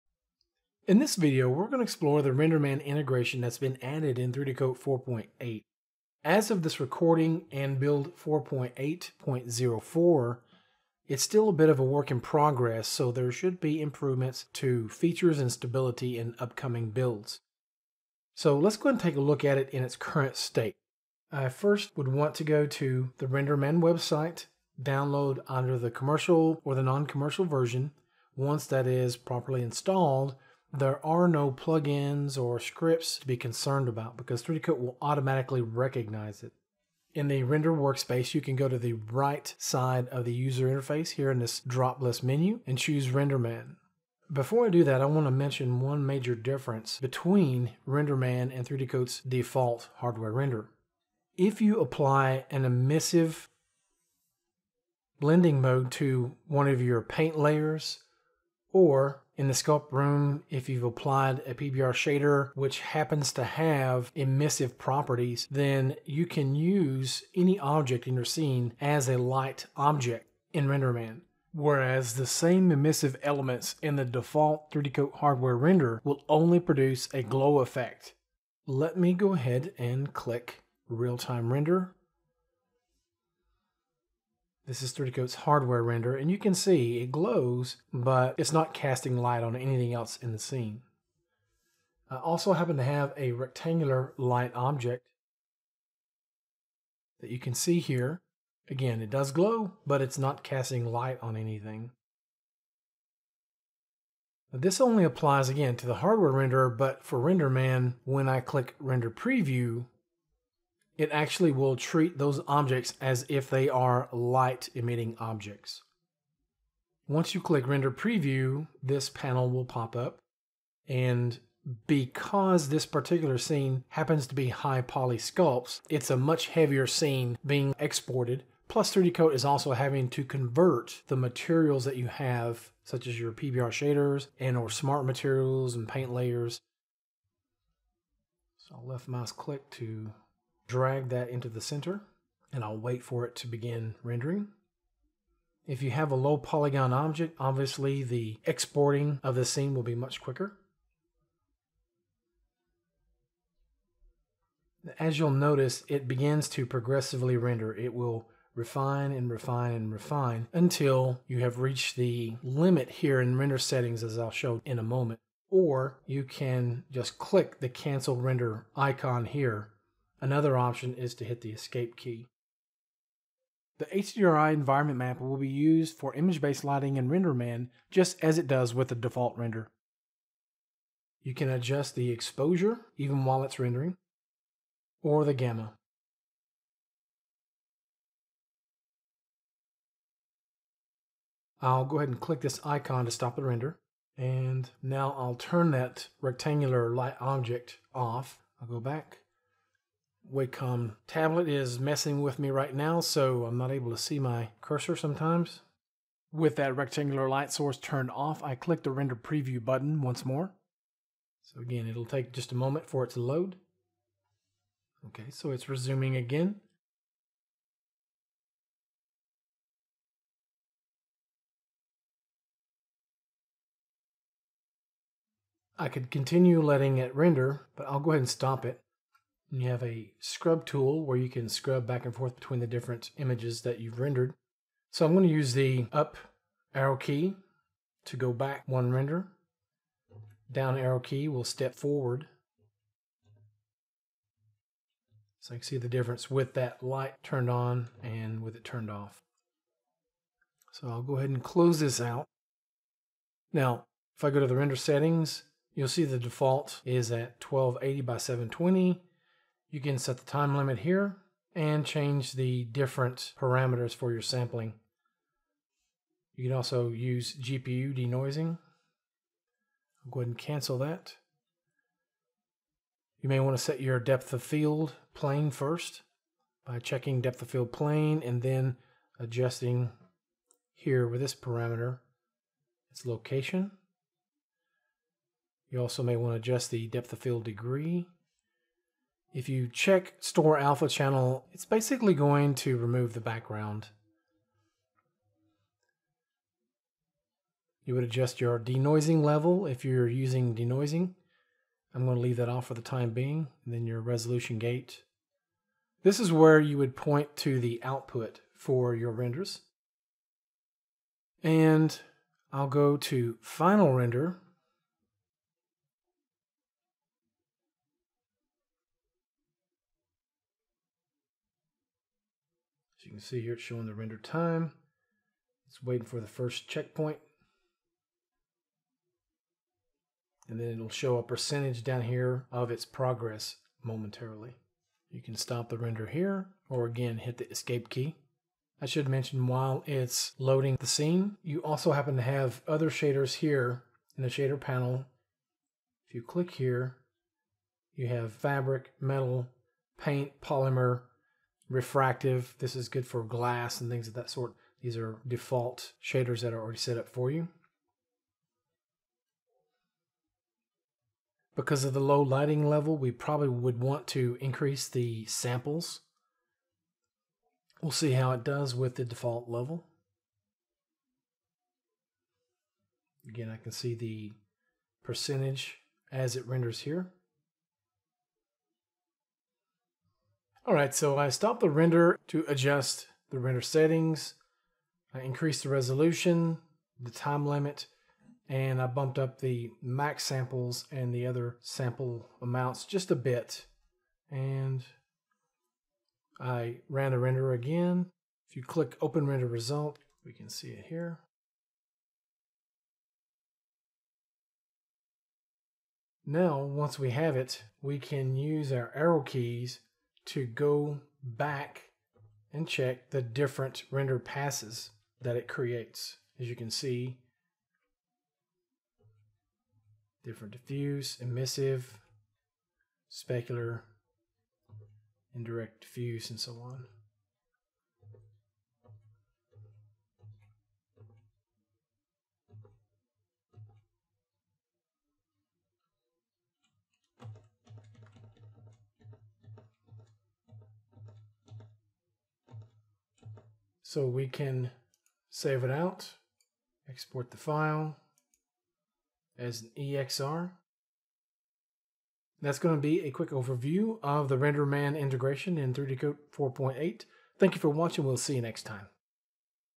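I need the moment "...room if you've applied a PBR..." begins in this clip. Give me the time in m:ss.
0:59.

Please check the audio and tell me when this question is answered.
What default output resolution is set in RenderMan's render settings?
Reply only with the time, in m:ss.
4:17.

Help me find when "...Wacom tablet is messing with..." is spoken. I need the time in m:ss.
3:20.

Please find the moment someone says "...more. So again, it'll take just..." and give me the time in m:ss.
3:30.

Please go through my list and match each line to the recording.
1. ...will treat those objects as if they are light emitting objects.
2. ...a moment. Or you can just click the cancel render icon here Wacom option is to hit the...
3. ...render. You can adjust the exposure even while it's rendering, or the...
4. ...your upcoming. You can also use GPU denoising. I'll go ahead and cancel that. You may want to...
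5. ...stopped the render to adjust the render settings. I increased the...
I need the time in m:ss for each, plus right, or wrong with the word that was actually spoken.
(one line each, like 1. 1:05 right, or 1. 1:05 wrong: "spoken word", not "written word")
1. 1:51 right
2. 2:44 wrong: "Another", not "Wacom"
3. 2:59 right
4. 4:24 wrong: "sampling", not "upcoming"
5. 6:21 right.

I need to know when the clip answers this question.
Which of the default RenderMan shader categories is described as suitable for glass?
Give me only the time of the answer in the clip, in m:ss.
5:51.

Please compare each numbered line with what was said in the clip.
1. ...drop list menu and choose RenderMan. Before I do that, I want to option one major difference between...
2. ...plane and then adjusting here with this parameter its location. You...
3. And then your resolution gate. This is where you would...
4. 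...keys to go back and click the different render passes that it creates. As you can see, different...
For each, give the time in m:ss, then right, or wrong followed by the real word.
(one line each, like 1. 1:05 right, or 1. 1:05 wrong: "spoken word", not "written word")
1. 0:41 wrong: "mention", not "option"
2. 4:37 right
3. 5:03 right
4. 6:49 wrong: "check", not "click".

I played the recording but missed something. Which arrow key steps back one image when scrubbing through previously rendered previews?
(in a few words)
Up arrow.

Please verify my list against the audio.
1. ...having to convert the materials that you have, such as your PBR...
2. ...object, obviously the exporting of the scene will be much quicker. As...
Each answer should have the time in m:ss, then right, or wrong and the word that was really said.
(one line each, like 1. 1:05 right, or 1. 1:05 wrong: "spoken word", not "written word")
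1. 2:09 right
2. 2:26 right.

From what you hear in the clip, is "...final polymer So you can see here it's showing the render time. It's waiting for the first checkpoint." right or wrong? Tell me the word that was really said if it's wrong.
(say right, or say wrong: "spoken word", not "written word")
wrong: "render", not "polymer".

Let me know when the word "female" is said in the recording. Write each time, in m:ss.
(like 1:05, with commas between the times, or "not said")
not said.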